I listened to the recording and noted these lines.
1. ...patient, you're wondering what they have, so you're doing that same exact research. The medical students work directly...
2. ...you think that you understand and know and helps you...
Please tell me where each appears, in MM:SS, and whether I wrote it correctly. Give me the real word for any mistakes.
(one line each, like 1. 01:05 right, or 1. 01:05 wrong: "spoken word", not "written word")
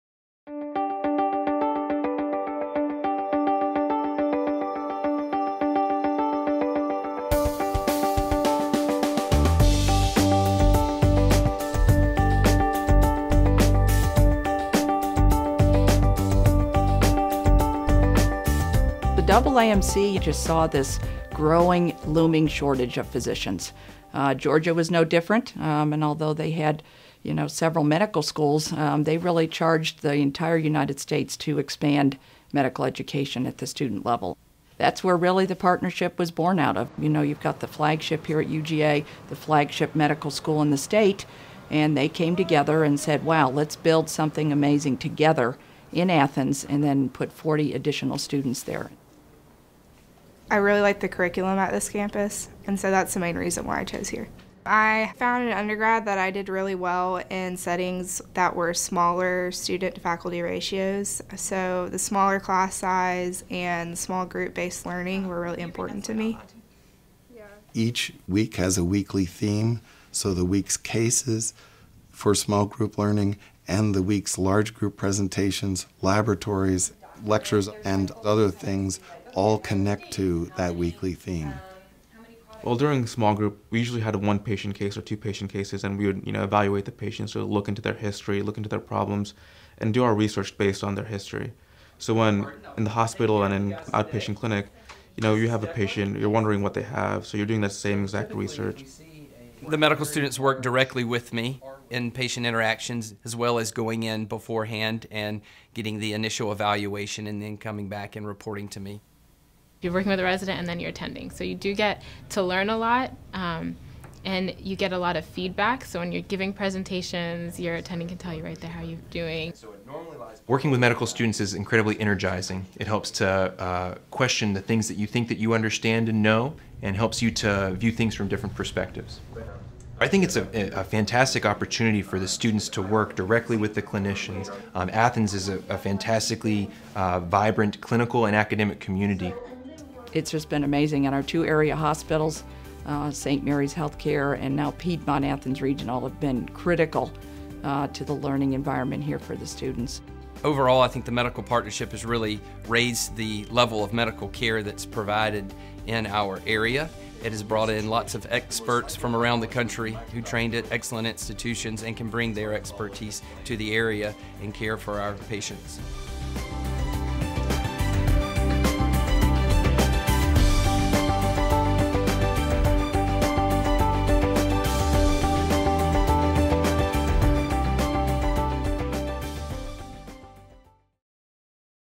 1. 01:35 right
2. 02:04 right.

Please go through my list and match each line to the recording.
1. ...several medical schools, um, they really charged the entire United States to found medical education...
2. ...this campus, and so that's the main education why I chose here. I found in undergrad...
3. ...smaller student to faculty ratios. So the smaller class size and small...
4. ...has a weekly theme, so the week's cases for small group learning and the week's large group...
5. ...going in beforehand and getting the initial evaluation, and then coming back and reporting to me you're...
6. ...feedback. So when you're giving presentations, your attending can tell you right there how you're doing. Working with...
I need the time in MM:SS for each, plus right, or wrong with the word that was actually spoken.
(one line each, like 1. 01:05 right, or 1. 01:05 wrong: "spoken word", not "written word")
1. 00:27 wrong: "expand", not "found"
2. 00:51 wrong: "reason", not "education"
3. 00:58 right
4. 01:08 right
5. 01:43 right
6. 01:55 right.